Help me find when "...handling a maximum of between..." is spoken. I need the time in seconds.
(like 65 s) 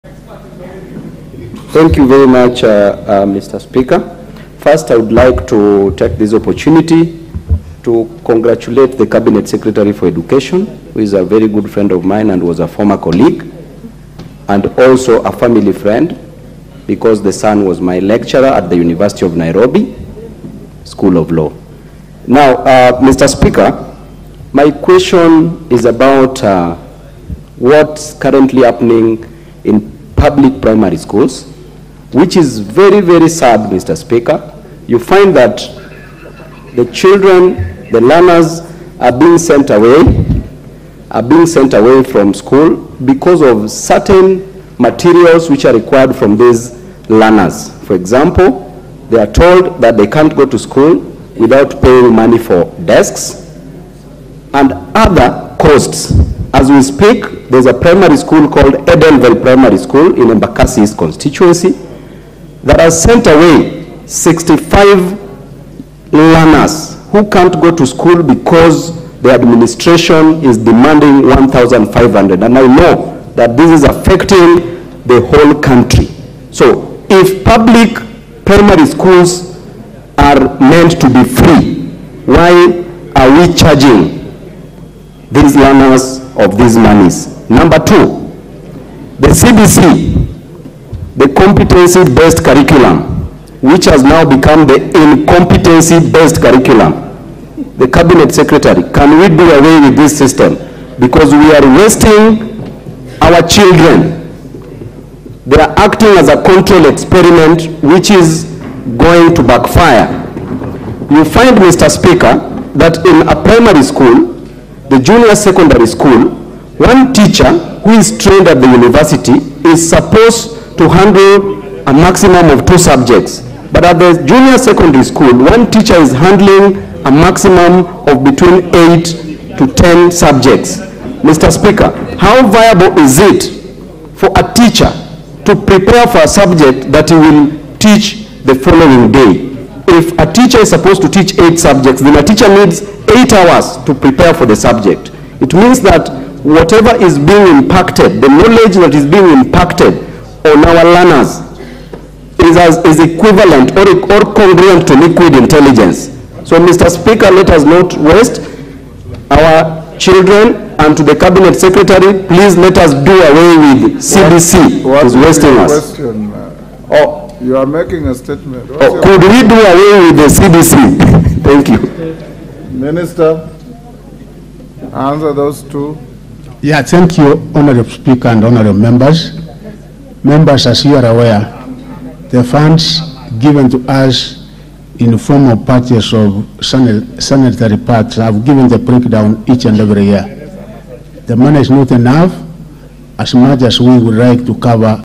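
126 s.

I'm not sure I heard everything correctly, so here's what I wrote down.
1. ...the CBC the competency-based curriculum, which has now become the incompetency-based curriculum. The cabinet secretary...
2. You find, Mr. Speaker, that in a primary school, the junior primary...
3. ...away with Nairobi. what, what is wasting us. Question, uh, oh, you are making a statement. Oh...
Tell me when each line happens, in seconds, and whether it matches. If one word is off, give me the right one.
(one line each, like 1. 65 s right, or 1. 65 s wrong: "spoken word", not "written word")
1. 89 s right
2. 111 s wrong: "secondary", not "primary"
3. 163 s wrong: "CBC", not "Nairobi".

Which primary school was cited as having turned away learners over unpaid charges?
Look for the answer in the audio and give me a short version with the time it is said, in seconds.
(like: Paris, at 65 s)
Edenville Primary School, at 58 s.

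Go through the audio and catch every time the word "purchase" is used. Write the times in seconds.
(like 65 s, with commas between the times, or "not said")
185 s.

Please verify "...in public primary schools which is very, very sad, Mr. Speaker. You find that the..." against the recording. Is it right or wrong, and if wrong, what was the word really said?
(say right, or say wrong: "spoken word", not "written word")
right.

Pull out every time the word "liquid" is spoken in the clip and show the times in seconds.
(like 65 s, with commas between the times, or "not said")
154 s.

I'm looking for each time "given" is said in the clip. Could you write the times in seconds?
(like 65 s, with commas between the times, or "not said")
183 s, 188 s.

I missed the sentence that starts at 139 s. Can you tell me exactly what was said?
If a teacher is supposed to teach eight subjects, then a teacher needs eight hours to prepare for the subject.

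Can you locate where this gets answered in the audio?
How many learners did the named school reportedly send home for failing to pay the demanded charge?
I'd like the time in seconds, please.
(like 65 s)
64 s.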